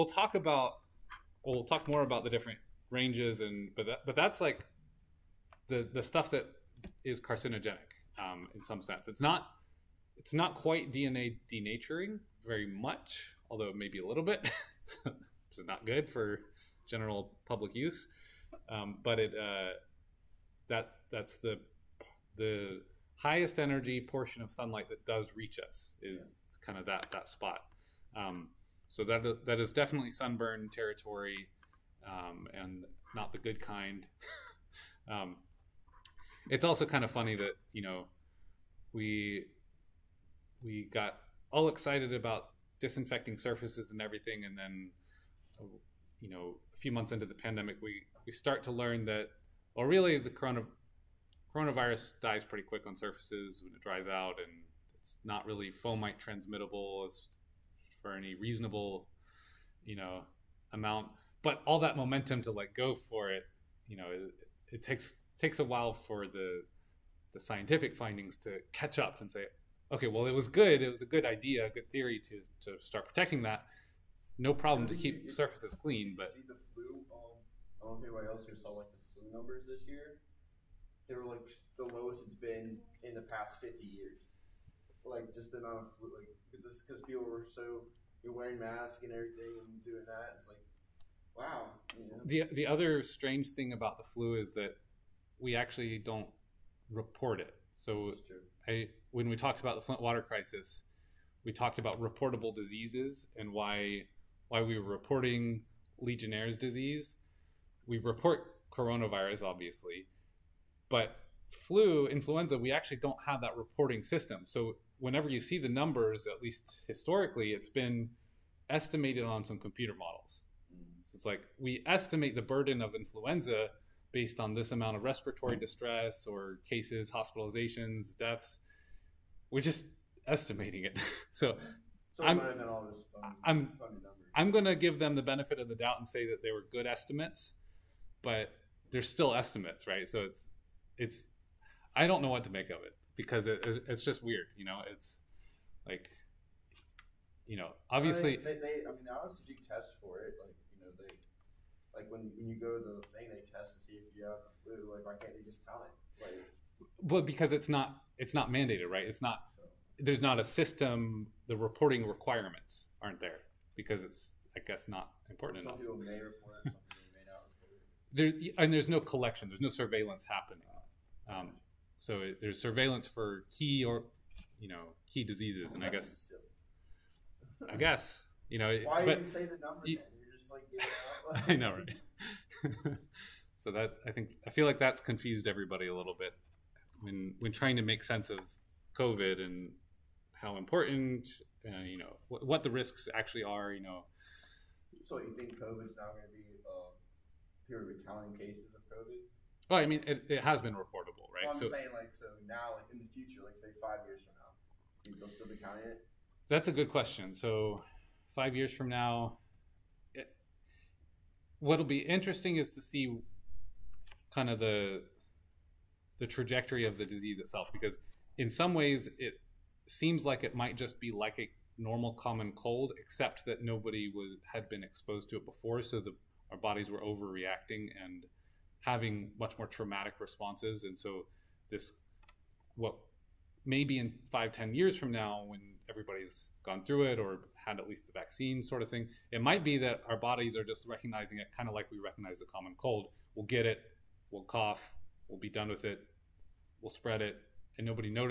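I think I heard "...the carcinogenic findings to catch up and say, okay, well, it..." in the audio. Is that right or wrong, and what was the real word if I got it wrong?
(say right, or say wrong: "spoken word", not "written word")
wrong: "scientific", not "carcinogenic".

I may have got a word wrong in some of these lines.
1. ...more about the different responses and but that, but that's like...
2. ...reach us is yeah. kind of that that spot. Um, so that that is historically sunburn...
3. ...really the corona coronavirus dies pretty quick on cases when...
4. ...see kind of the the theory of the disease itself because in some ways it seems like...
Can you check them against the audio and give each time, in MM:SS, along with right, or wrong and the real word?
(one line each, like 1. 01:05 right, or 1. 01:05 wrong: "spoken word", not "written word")
1. 00:01 wrong: "ranges", not "responses"
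2. 00:25 wrong: "definitely", not "historically"
3. 00:49 wrong: "surfaces", not "cases"
4. 03:32 wrong: "trajectory", not "theory".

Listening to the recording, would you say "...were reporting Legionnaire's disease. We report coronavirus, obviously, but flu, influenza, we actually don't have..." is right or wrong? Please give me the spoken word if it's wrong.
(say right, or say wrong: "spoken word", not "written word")
right.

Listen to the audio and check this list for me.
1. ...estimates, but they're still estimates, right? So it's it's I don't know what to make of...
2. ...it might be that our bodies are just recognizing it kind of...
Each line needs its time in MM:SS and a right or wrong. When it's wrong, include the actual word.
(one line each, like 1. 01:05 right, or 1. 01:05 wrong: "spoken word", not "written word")
1. 02:16 right
2. 03:59 right.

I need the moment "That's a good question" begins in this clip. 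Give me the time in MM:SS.
03:26.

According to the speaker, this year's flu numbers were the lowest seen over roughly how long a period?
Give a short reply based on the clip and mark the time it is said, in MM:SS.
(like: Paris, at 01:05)
50 years, at 01:23.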